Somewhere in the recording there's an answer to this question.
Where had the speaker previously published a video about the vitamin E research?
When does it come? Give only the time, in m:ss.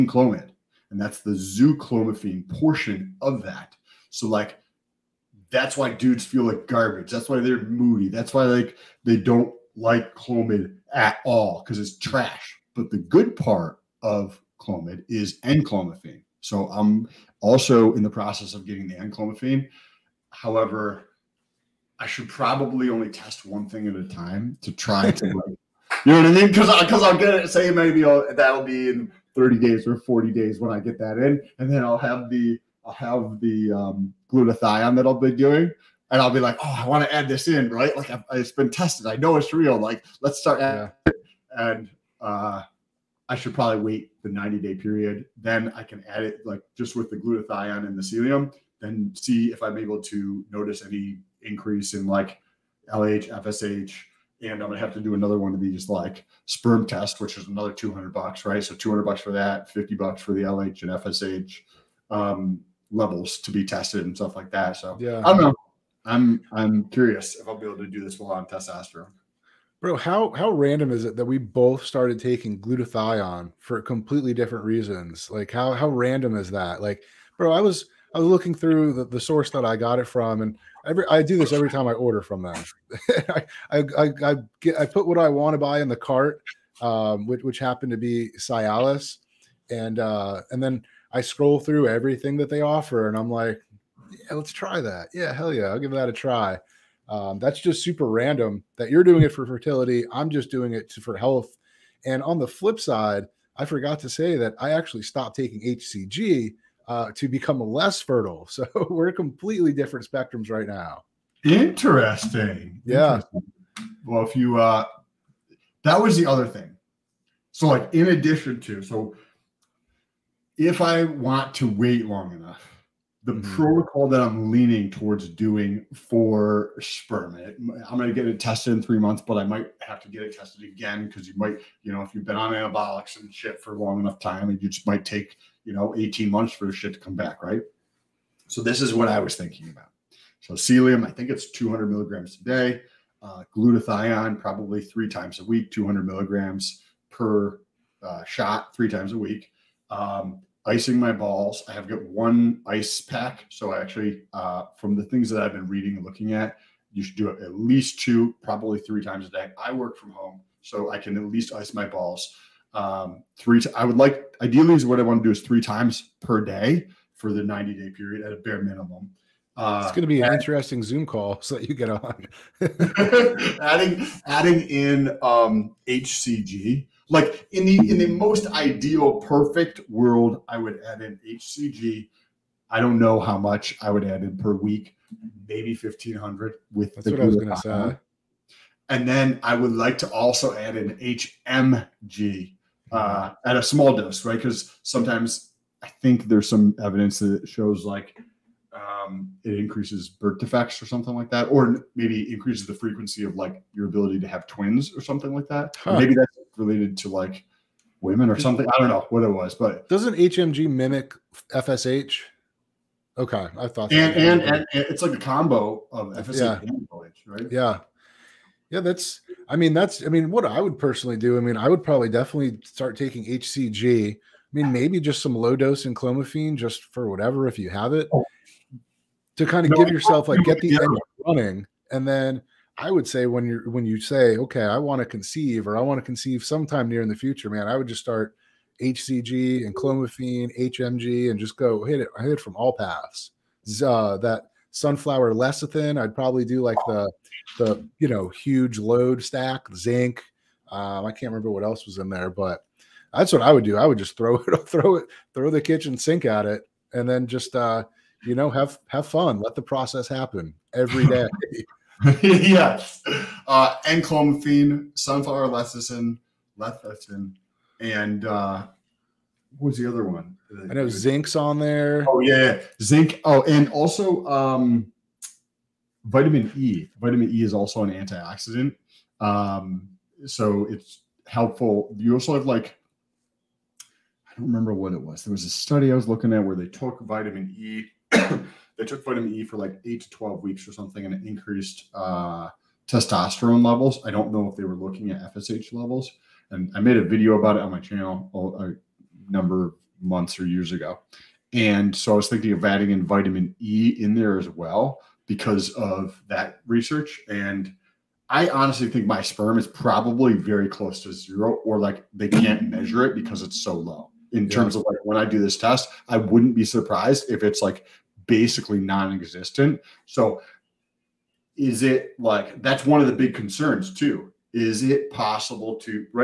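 4:57.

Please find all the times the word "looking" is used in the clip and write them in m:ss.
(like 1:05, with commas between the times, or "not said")
1:18, 2:36, 4:46, 4:54.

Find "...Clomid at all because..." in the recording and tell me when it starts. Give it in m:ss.
0:10.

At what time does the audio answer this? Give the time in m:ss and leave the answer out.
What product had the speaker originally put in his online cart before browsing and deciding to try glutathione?
1:28.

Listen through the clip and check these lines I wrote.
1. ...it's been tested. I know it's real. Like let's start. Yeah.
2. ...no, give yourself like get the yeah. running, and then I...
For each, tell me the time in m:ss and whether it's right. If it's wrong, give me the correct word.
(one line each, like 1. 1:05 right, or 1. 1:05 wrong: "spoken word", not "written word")
1. 0:38 right
2. 3:49 right.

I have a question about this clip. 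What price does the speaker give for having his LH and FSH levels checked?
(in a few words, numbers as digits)
50 bucks.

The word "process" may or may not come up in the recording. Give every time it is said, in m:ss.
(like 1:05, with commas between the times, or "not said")
0:18, 4:19.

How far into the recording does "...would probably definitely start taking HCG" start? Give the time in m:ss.
3:41.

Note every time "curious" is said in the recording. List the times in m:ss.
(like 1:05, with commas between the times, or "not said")
1:06.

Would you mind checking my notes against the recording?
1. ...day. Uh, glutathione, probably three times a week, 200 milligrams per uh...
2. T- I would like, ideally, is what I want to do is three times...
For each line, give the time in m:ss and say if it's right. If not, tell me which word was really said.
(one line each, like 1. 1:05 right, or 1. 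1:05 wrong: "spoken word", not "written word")
1. 2:22 right
2. 2:43 right.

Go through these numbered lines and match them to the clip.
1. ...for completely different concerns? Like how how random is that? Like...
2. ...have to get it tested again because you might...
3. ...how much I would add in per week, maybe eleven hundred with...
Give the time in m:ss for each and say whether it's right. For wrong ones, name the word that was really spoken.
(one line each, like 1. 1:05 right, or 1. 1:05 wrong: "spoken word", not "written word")
1. 1:13 wrong: "reasons", not "concerns"
2. 2:09 right
3. 3:03 wrong: "fifteen", not "eleven".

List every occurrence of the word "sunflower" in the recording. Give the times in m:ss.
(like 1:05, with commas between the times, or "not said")
4:04, 4:24.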